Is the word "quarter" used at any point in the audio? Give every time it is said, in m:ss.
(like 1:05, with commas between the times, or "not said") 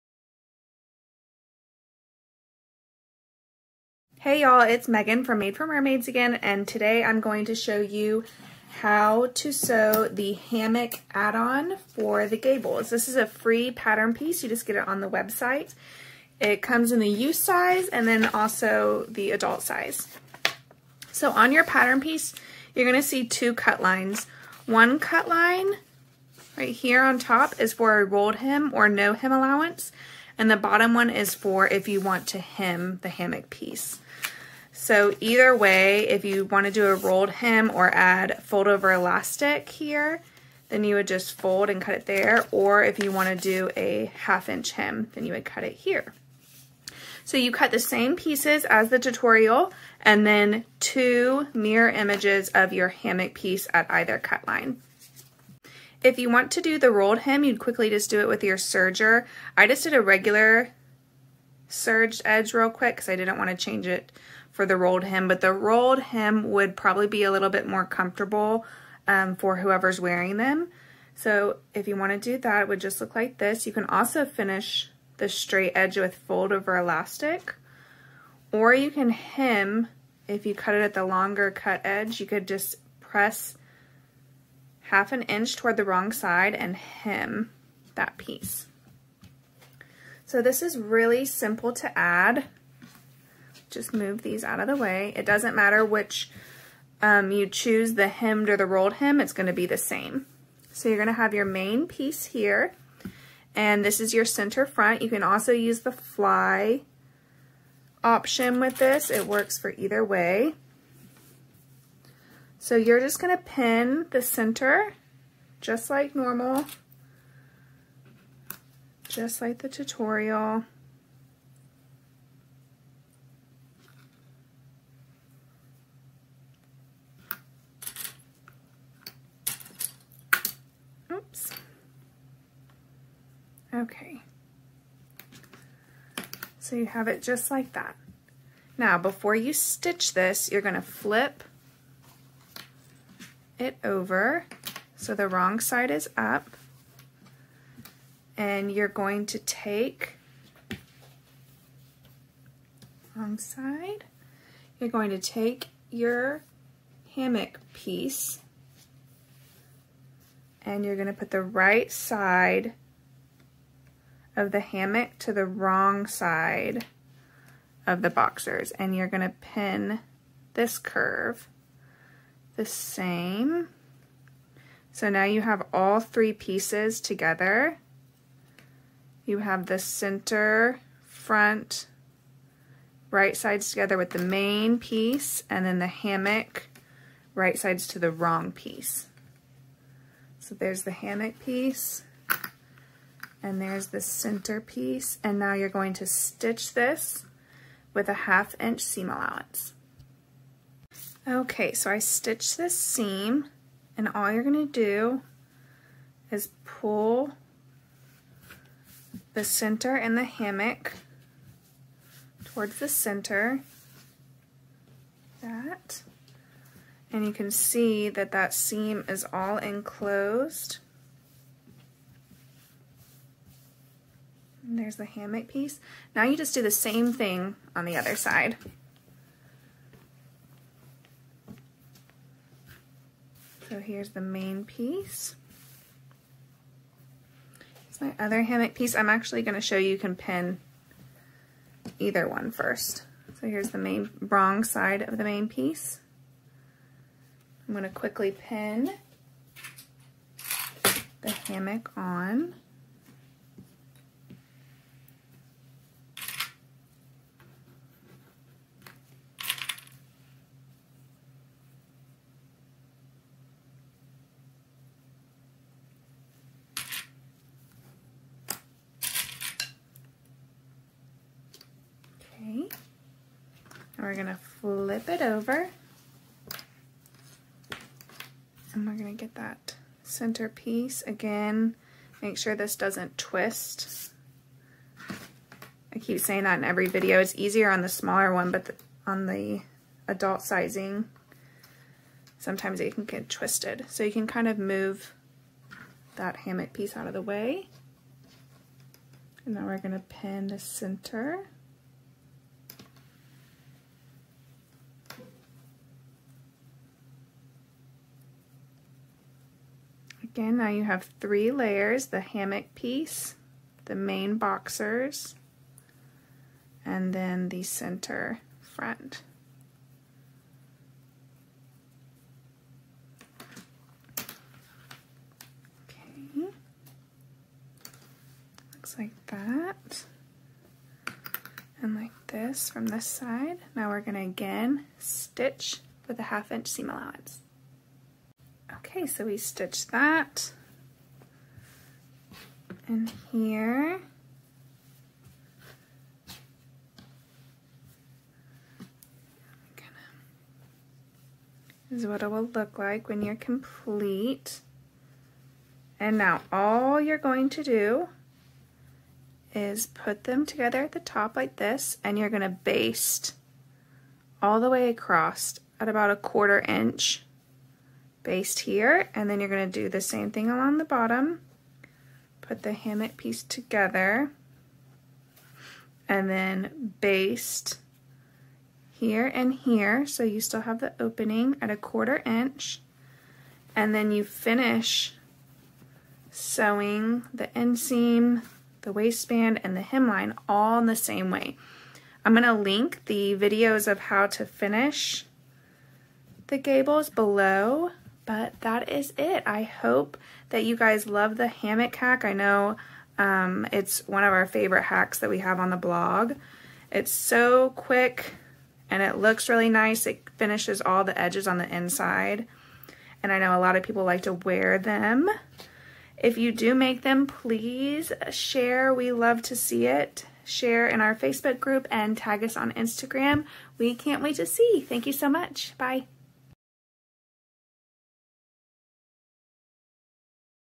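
6:06, 6:21.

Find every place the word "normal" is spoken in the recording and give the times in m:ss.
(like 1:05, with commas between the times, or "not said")
1:56.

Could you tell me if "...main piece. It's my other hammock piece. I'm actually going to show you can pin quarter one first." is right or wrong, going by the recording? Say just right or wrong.
wrong.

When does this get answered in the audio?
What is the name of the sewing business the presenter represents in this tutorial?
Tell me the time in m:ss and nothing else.
0:05.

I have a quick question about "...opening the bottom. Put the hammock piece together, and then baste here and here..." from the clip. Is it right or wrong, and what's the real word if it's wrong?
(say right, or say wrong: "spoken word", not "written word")
wrong: "along", not "opening".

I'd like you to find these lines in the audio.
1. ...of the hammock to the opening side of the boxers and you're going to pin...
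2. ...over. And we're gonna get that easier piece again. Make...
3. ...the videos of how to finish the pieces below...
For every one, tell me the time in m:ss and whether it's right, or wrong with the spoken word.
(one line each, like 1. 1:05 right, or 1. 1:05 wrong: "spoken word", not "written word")
1. 2:44 wrong: "wrong", not "opening"
2. 4:35 wrong: "center", not "easier"
3. 6:33 wrong: "gables", not "pieces".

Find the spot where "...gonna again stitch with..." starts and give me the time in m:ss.
5:33.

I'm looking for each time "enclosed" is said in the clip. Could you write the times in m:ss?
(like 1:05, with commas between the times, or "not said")
3:39.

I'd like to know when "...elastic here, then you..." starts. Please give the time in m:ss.
0:38.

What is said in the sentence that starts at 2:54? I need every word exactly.
So now you have all three pieces together.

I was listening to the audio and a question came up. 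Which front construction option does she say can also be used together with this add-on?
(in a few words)
fly option.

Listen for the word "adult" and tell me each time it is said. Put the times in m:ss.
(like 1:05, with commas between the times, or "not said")
0:19, 4:50.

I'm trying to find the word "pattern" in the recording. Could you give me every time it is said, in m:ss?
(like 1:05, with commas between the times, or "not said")
0:13, 0:21.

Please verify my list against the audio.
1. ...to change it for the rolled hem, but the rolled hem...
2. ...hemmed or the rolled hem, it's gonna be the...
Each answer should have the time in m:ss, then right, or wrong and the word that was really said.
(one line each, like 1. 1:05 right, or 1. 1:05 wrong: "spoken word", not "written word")
1. 1:03 right
2. 1:38 right.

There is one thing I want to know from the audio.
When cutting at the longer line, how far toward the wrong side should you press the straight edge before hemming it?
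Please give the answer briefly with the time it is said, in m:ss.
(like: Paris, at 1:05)
half an inch, at 1:24.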